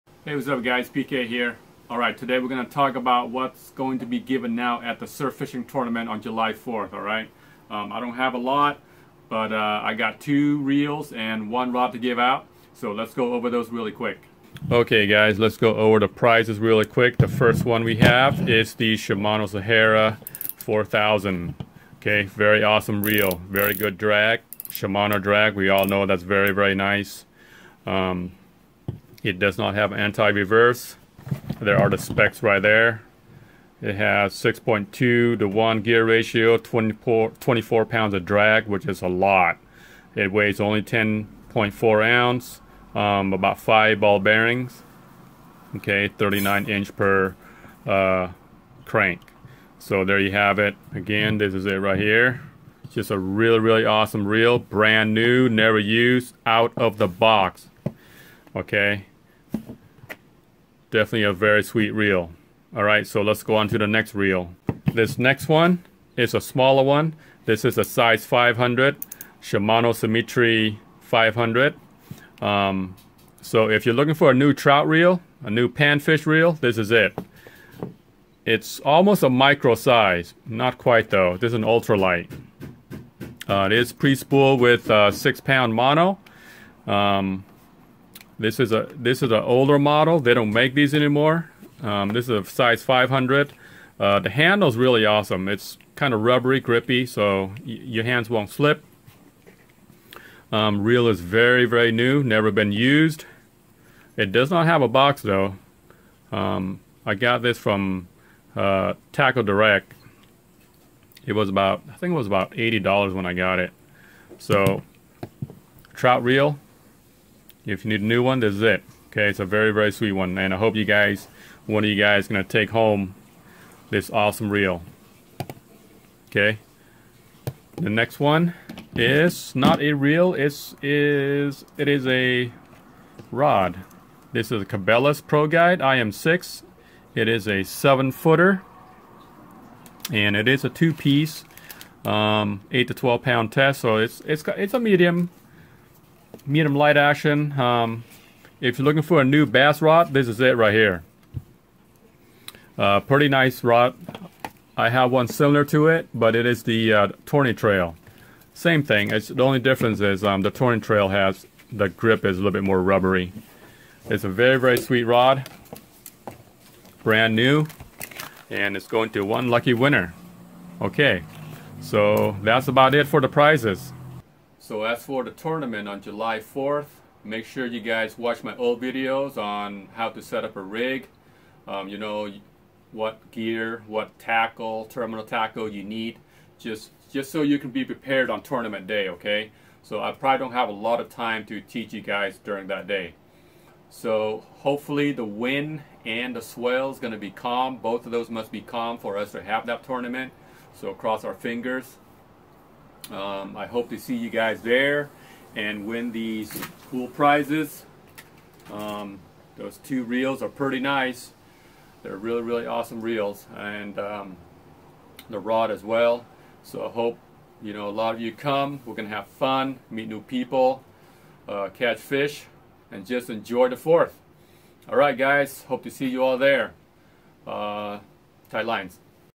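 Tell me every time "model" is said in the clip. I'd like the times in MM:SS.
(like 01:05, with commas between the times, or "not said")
01:29.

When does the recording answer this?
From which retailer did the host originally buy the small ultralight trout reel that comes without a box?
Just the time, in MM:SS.
01:49.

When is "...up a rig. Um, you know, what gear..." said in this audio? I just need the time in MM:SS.
03:00.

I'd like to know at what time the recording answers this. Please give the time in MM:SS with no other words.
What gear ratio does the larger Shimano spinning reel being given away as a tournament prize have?
00:34.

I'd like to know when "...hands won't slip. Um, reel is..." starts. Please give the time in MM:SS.
01:38.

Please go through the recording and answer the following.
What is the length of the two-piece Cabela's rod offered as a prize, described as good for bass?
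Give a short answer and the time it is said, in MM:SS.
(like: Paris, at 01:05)
7 feet, at 02:17.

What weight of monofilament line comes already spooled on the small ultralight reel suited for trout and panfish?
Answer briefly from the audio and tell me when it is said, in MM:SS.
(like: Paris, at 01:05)
6 pound, at 01:25.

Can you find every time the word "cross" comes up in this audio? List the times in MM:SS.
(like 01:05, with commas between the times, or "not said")
03:20.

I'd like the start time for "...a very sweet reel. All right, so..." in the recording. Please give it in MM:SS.
01:01.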